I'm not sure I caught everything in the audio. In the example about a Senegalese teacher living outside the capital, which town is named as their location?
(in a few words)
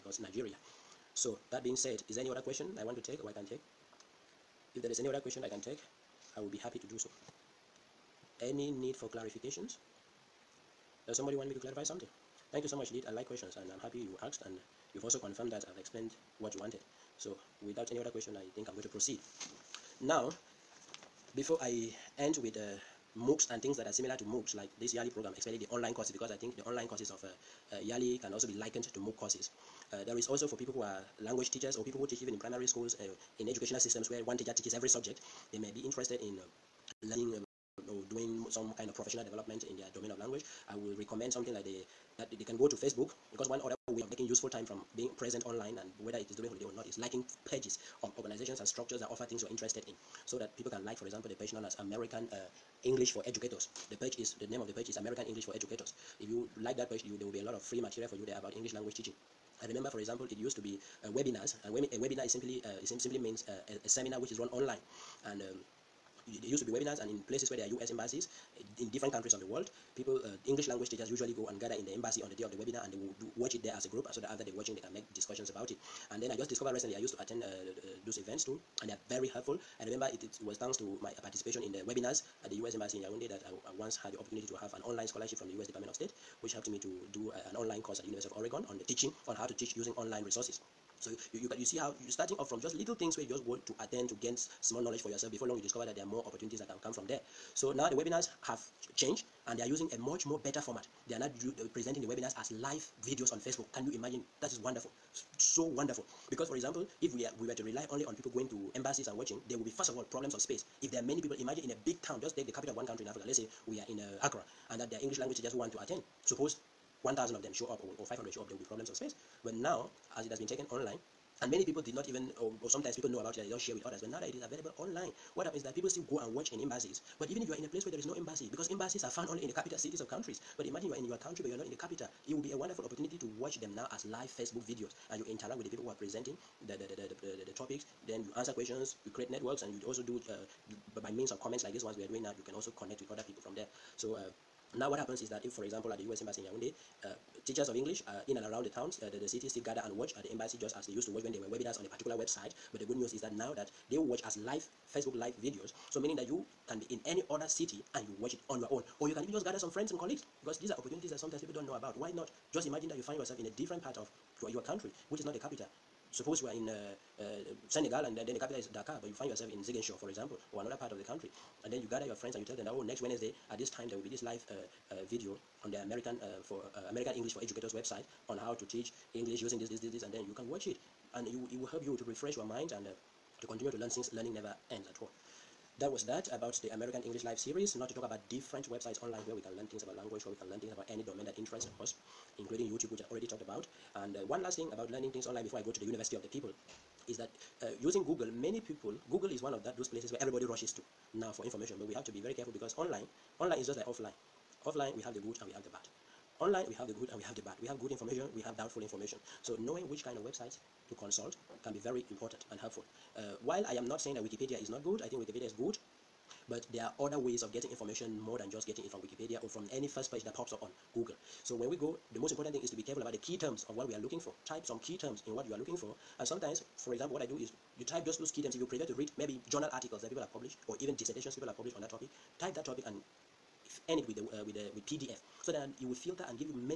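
Ziguinchor.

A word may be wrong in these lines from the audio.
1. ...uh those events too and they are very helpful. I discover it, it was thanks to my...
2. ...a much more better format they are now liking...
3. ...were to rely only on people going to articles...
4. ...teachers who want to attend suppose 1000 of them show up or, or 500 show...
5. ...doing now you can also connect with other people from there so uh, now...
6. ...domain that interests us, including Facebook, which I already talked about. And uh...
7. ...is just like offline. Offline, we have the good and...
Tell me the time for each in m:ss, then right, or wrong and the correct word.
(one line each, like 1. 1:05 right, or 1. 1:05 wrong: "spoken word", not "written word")
1. 1:17 wrong: "remember", not "discover"
2. 1:39 wrong: "presenting", not "liking"
3. 1:47 wrong: "embassies", not "articles"
4. 1:55 right
5. 2:22 right
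6. 3:11 wrong: "YouTube", not "Facebook"
7. 3:23 right.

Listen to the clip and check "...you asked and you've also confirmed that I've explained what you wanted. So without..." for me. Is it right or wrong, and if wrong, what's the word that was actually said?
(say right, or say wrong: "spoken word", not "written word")
right.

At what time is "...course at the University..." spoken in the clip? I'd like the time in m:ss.
1:27.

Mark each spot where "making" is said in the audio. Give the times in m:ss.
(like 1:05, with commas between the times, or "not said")
0:44.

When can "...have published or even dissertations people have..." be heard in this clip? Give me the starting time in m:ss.
3:50.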